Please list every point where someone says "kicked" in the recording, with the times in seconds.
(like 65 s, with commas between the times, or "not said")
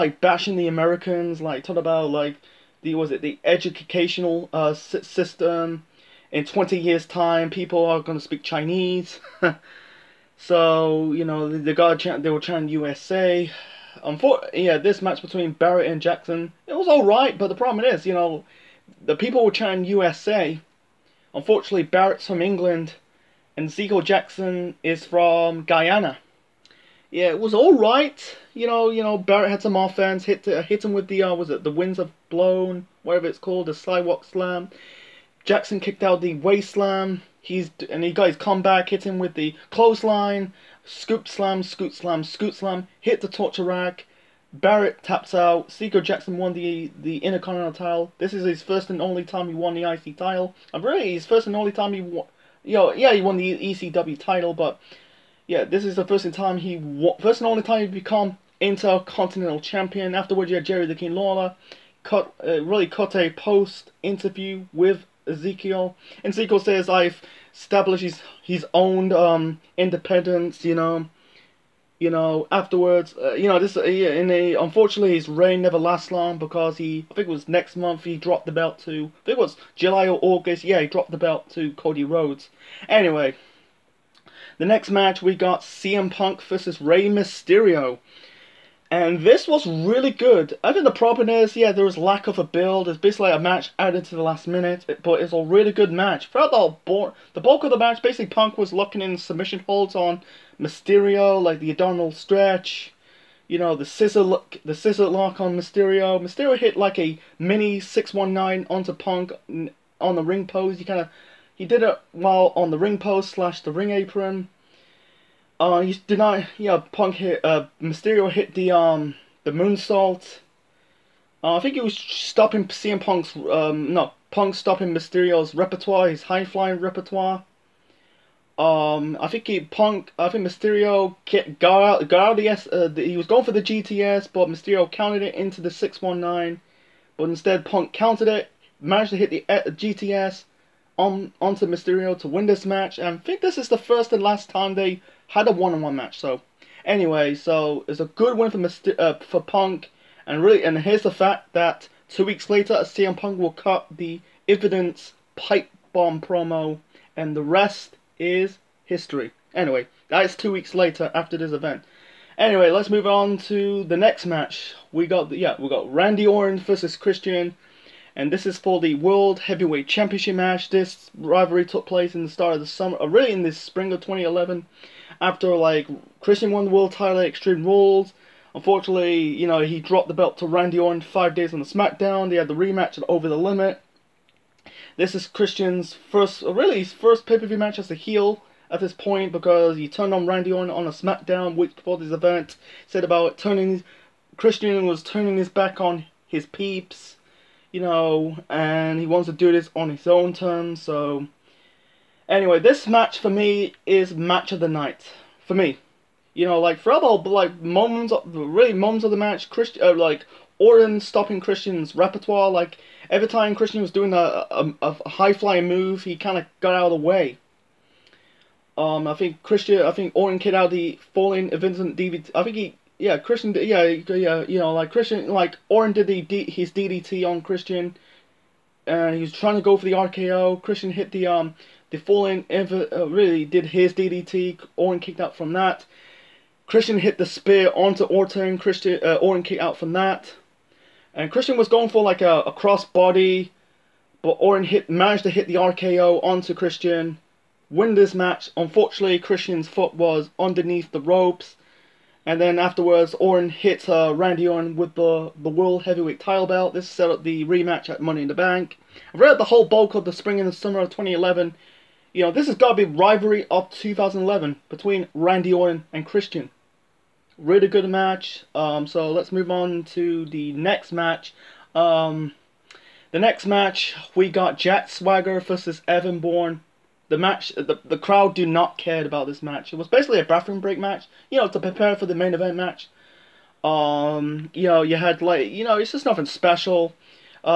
35 s, 220 s, 234 s, 239 s.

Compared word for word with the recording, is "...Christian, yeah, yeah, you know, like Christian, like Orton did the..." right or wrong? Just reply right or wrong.
right.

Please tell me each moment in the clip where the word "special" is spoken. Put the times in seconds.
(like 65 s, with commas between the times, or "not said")
286 s.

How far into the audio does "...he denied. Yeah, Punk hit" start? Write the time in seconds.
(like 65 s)
115 s.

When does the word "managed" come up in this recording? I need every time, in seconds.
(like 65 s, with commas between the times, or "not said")
138 s, 244 s.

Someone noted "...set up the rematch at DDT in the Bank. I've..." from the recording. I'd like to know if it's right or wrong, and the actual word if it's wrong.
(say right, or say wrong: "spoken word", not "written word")
wrong: "Money", not "DDT".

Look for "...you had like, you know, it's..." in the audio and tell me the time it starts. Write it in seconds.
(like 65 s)
284 s.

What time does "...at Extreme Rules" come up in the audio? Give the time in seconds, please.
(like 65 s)
177 s.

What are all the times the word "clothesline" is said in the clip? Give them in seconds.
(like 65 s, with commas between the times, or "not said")
39 s.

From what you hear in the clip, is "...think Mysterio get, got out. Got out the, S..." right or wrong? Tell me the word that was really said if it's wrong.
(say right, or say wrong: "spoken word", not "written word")
right.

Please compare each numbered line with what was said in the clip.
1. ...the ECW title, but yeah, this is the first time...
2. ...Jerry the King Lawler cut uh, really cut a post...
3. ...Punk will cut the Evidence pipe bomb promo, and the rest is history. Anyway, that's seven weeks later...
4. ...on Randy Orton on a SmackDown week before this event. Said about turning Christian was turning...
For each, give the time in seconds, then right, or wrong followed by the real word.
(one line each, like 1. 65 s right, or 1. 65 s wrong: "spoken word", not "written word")
1. 53 s right
2. 60 s right
3. 153 s wrong: "two", not "seven"
4. 190 s right.